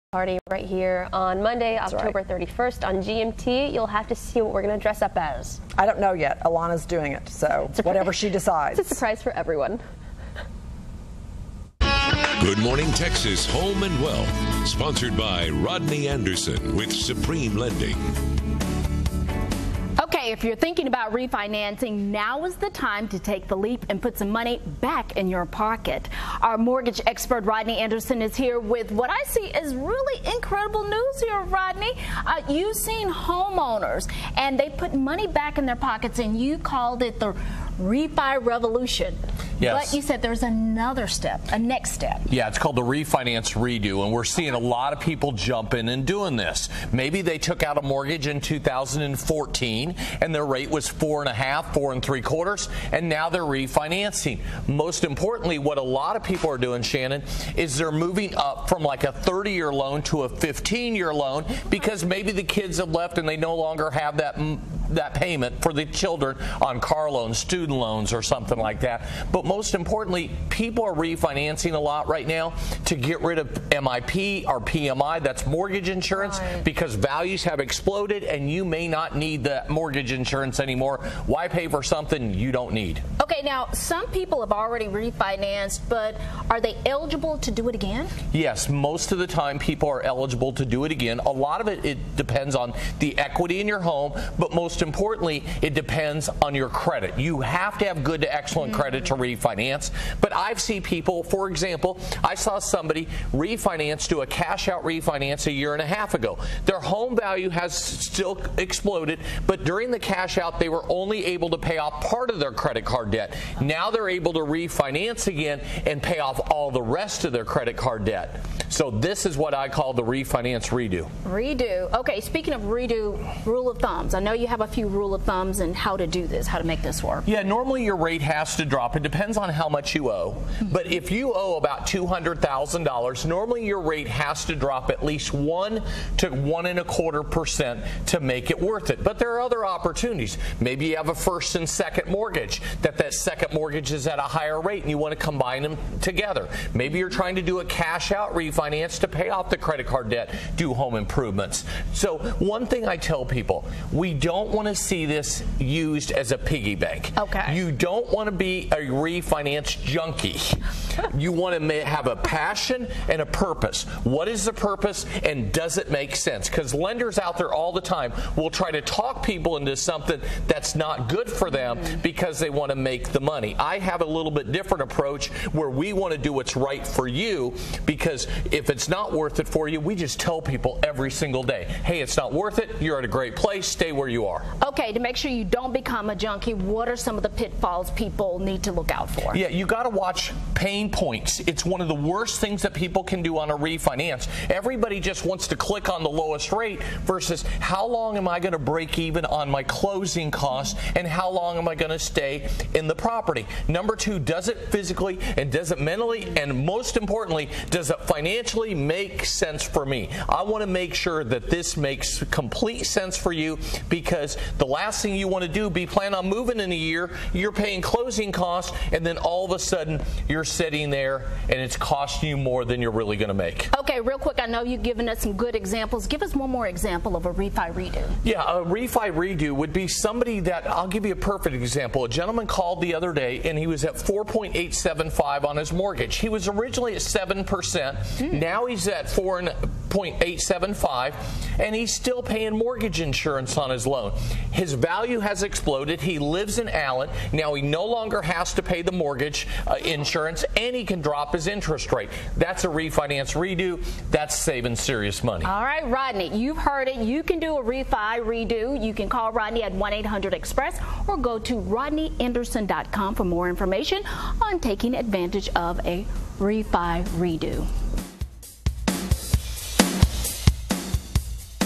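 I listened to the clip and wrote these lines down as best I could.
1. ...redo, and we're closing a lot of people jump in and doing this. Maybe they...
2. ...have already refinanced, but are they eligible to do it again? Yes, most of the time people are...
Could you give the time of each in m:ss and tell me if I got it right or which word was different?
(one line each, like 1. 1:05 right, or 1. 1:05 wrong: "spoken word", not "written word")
1. 0:43 wrong: "seeing", not "closing"
2. 1:24 right.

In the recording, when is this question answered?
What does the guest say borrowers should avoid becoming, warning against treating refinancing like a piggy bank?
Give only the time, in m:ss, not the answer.
2:38.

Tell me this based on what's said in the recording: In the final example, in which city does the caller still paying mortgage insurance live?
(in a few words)
Allen.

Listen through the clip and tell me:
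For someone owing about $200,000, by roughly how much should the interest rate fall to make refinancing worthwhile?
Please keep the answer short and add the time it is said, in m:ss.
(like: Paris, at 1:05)
1 to 1.25 percent, at 2:15.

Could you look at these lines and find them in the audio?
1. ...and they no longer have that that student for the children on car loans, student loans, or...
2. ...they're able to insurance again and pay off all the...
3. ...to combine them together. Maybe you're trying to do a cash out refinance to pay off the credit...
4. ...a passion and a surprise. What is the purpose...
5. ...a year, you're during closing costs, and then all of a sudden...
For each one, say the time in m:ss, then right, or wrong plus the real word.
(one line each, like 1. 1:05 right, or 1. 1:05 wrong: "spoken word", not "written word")
1. 1:03 wrong: "payment", not "student"
2. 1:53 wrong: "refinance", not "insurance"
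3. 2:25 right
4. 2:42 wrong: "purpose", not "surprise"
5. 3:36 wrong: "paying", not "during".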